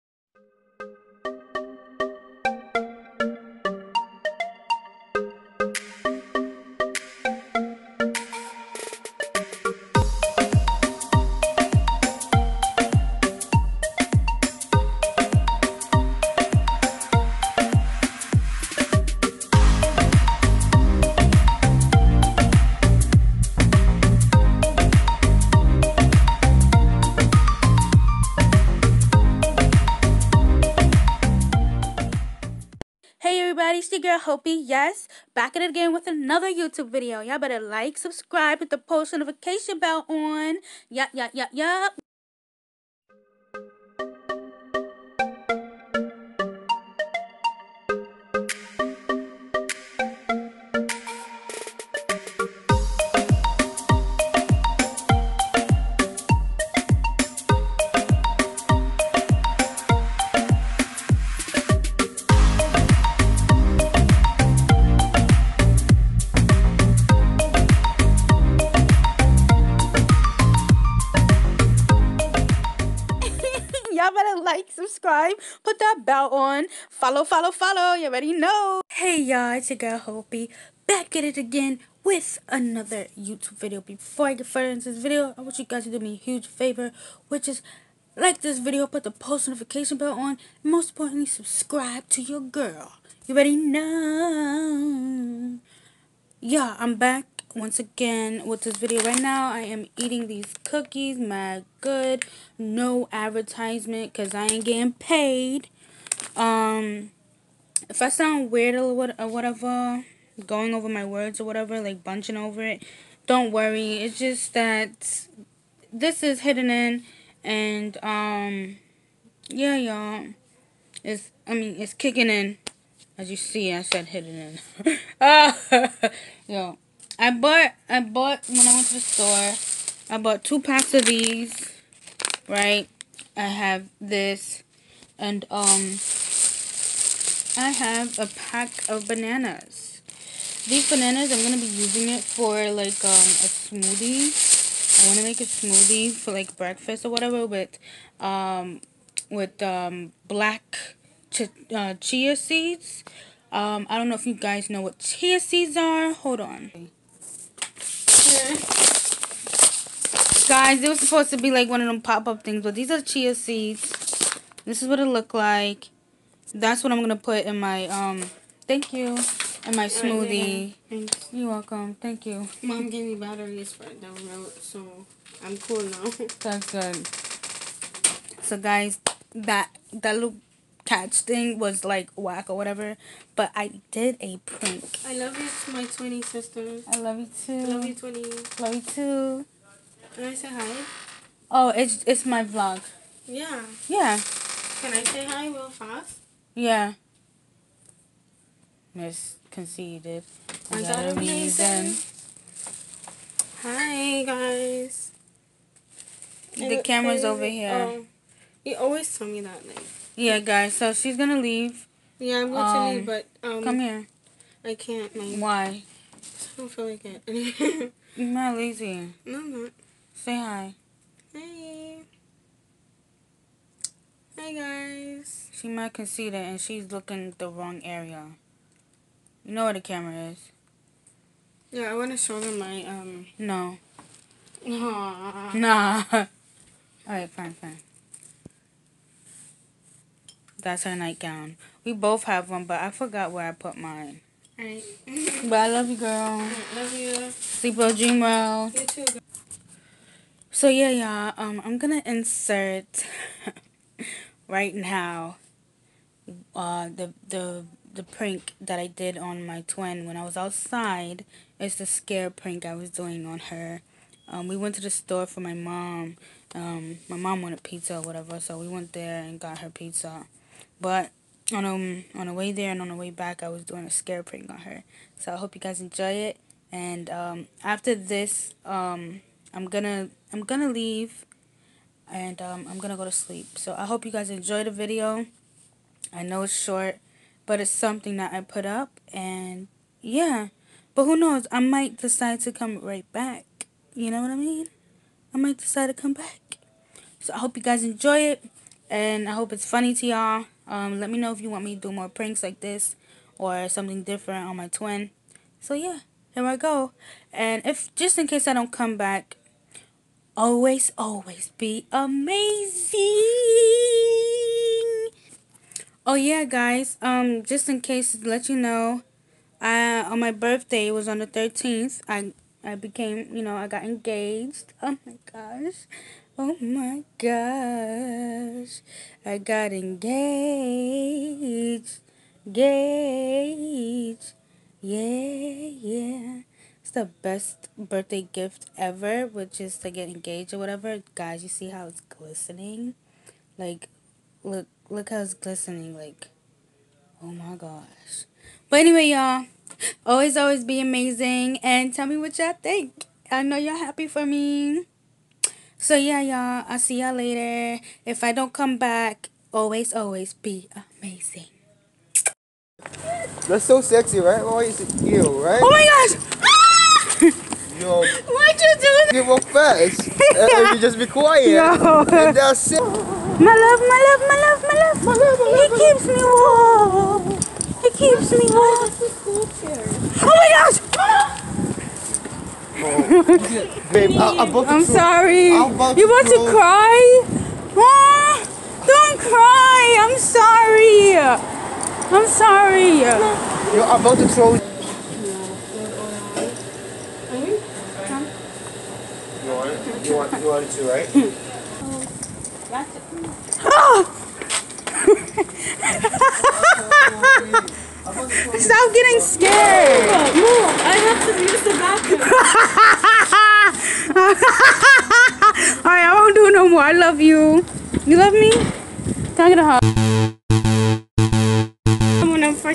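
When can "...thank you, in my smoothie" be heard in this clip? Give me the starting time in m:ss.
2:48.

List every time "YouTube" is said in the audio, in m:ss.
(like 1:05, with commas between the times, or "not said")
0:36, 1:23.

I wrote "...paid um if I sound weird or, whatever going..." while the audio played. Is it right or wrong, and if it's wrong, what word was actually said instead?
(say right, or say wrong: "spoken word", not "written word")
right.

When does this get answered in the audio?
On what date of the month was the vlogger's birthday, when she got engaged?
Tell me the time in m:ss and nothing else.
5:21.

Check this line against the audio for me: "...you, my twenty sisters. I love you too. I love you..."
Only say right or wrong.
right.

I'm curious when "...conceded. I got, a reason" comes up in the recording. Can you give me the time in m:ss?
3:19.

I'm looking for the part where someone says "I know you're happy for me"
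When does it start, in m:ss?
5:53.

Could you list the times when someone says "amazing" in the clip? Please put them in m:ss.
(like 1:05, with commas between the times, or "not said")
5:11, 5:50, 6:01.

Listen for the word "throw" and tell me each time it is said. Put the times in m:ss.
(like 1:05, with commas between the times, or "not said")
6:34.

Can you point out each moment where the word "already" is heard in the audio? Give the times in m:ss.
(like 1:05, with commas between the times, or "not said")
1:18, 1:33.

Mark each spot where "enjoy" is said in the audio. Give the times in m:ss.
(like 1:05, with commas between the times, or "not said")
4:35, 4:44, 4:57.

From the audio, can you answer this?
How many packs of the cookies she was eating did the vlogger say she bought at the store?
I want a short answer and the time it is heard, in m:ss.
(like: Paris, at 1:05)
2, at 2:10.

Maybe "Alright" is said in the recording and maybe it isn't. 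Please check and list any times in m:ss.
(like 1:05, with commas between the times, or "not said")
4:04.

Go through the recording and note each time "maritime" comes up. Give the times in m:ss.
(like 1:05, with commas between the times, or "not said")
not said.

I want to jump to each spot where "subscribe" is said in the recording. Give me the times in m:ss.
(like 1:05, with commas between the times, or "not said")
0:37, 1:14, 1:31.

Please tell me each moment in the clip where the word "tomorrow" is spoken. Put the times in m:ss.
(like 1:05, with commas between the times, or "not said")
not said.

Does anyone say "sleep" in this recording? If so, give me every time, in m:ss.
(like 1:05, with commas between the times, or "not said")
4:07, 4:43.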